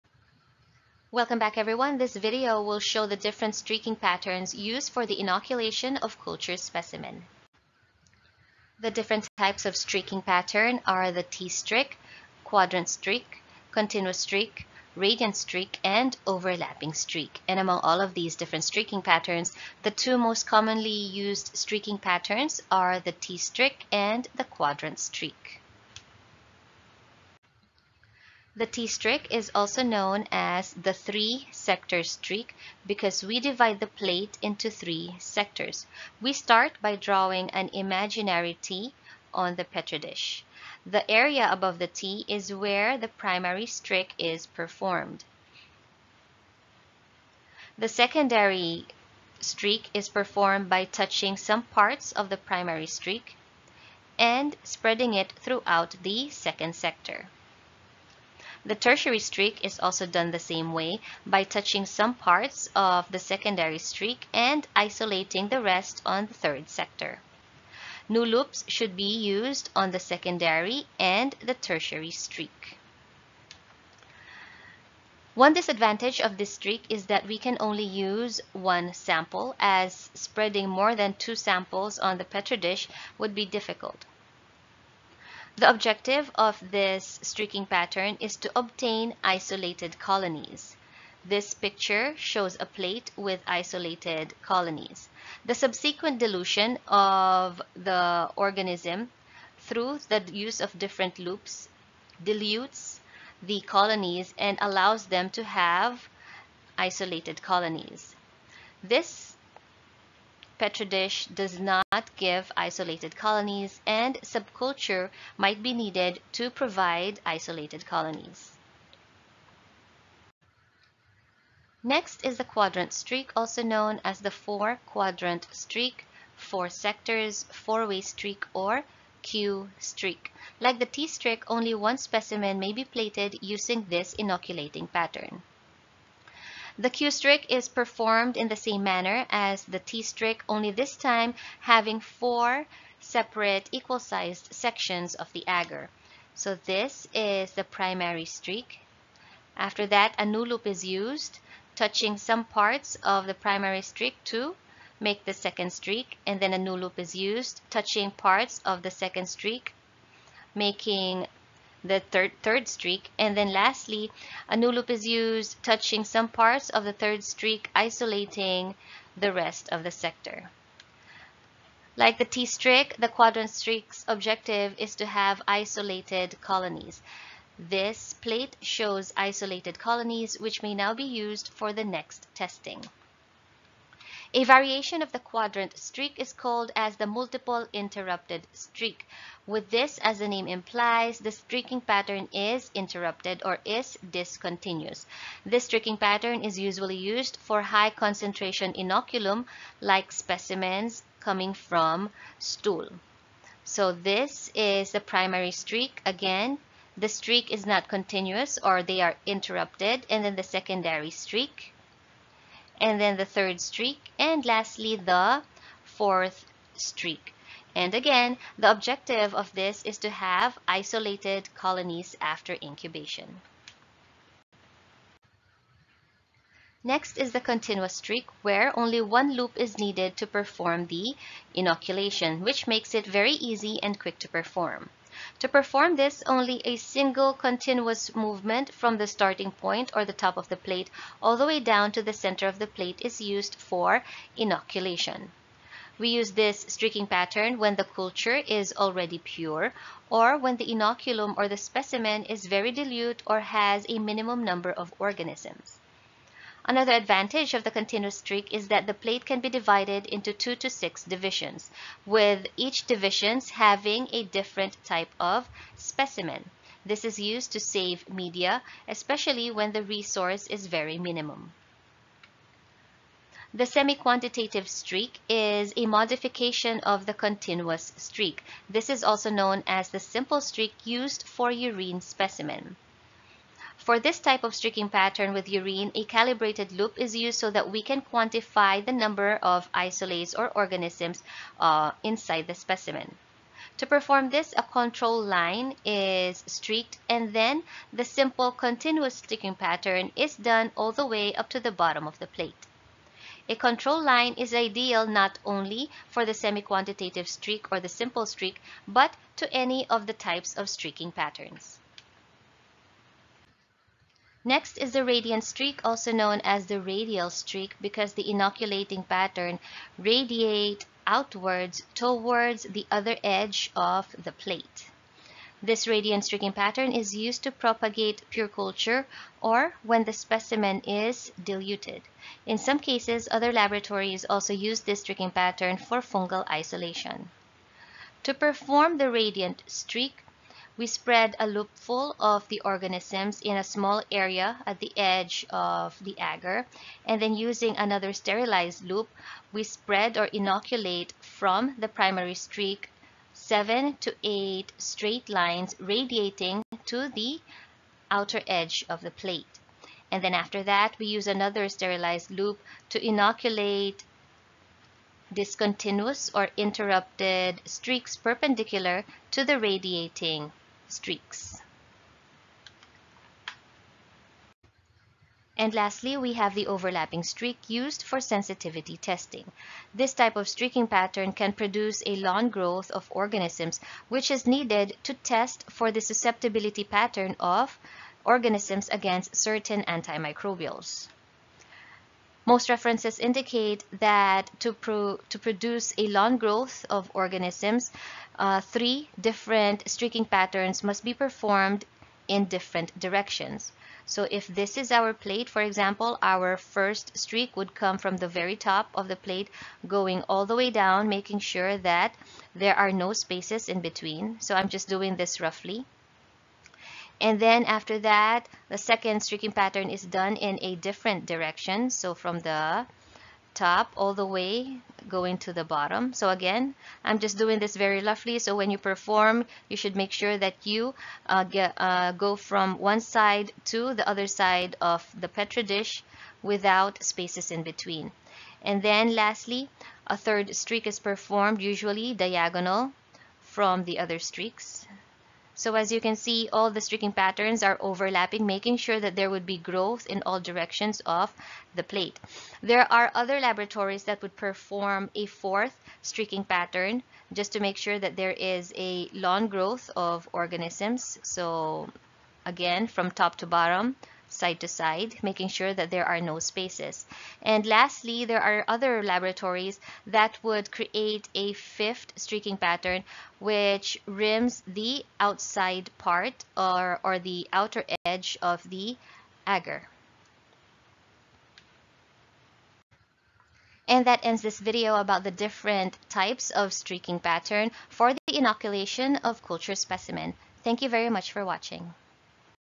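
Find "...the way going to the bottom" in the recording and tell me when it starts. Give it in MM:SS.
07:04.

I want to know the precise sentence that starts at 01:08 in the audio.
New loops should be used on the secondary and the tertiary streak.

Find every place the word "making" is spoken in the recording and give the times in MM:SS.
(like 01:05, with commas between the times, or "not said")
02:40, 06:51, 07:28, 07:45.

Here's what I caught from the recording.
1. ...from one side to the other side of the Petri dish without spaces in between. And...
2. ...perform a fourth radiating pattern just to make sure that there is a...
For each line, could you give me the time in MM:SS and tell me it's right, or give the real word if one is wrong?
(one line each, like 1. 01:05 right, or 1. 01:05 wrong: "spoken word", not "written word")
1. 07:12 right
2. 07:34 wrong: "streaking", not "radiating".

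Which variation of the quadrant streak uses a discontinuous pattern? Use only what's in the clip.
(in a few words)
Multiple interrupted streak.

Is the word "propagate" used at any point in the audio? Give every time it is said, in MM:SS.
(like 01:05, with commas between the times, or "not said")
05:27.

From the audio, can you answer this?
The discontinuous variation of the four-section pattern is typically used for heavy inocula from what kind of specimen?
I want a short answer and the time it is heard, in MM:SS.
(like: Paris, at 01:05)
Stool, at 03:22.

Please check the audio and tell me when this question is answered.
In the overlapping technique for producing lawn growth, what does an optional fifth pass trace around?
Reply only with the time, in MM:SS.
07:57.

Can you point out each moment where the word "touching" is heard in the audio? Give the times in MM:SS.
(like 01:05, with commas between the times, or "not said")
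00:50, 01:01, 02:31, 02:37, 02:45.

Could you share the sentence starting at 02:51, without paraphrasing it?
Like the T-streak, the quadrant streak's objective is to have isolated colonies.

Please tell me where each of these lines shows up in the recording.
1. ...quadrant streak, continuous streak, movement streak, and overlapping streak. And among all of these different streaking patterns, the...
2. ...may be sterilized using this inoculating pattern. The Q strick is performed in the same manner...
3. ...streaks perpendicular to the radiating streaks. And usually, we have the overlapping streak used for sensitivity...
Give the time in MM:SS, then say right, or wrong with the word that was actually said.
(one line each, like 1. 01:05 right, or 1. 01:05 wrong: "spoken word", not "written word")
1. 00:12 wrong: "radiant", not "movement"
2. 02:12 wrong: "plated", not "sterilized"
3. 06:07 wrong: "lastly", not "usually".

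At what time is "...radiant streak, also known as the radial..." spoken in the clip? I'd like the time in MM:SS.
05:15.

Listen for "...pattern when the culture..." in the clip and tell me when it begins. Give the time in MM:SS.
04:07.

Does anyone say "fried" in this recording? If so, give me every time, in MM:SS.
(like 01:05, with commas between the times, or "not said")
not said.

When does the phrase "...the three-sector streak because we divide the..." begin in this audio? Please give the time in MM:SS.
00:30.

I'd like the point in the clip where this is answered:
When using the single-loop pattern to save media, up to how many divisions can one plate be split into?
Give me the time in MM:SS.
04:20.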